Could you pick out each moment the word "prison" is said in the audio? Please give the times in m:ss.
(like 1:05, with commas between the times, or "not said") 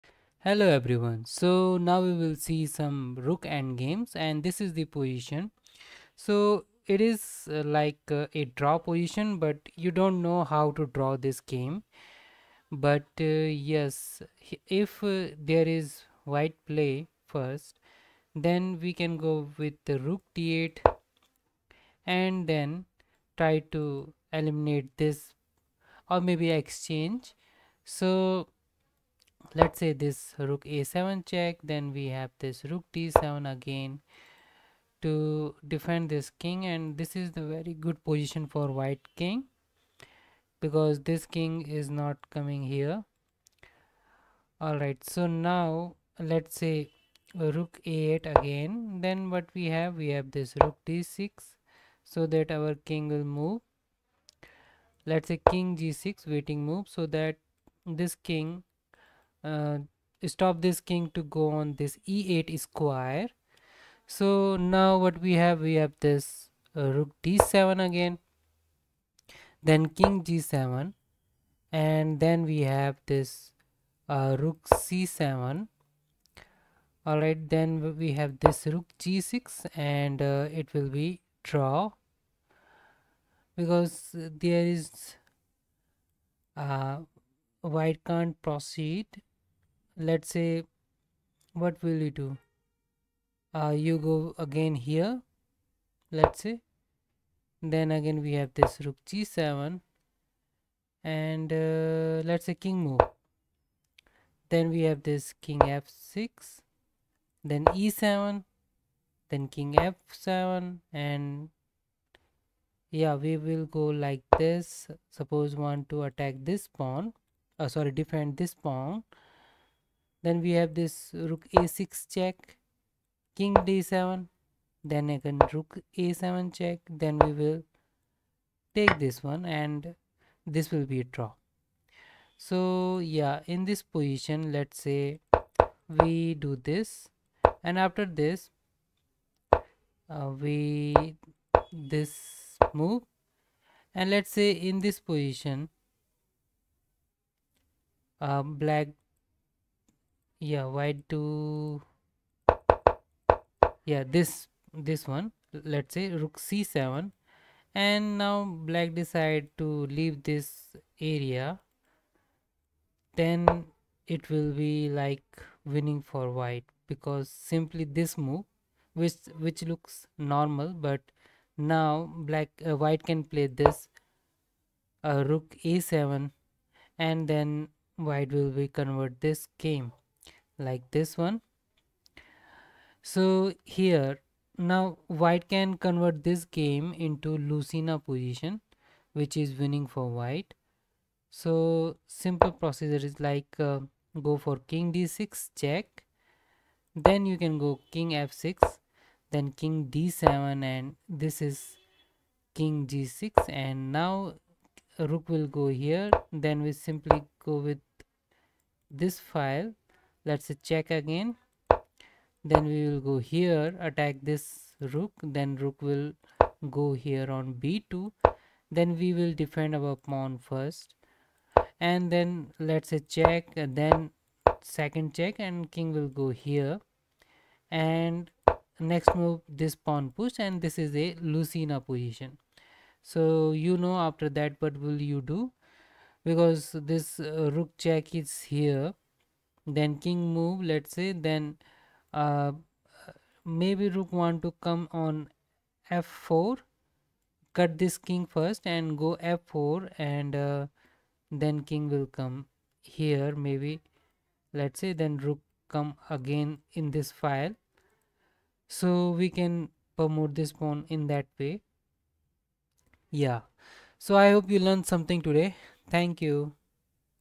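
not said.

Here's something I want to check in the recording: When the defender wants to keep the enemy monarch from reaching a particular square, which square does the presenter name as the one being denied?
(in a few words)
e8.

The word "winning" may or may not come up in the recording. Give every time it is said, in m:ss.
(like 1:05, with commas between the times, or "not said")
2:45, 3:09.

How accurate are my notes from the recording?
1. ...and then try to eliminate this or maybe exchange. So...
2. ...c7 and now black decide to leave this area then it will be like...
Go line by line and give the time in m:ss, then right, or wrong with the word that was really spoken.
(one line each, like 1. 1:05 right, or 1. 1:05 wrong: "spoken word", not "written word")
1. 0:22 right
2. 2:36 right.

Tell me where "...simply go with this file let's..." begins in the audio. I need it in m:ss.
3:26.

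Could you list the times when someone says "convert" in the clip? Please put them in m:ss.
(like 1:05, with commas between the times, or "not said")
2:58, 3:05.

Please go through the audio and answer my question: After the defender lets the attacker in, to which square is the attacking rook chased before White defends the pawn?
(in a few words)
b2.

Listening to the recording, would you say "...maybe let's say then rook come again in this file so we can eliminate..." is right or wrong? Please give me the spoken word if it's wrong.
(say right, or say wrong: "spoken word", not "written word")
wrong: "promote", not "eliminate".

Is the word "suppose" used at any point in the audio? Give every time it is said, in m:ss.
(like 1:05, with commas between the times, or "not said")
1:55.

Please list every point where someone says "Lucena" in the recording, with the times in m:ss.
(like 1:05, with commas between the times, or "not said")
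3:07, 3:51.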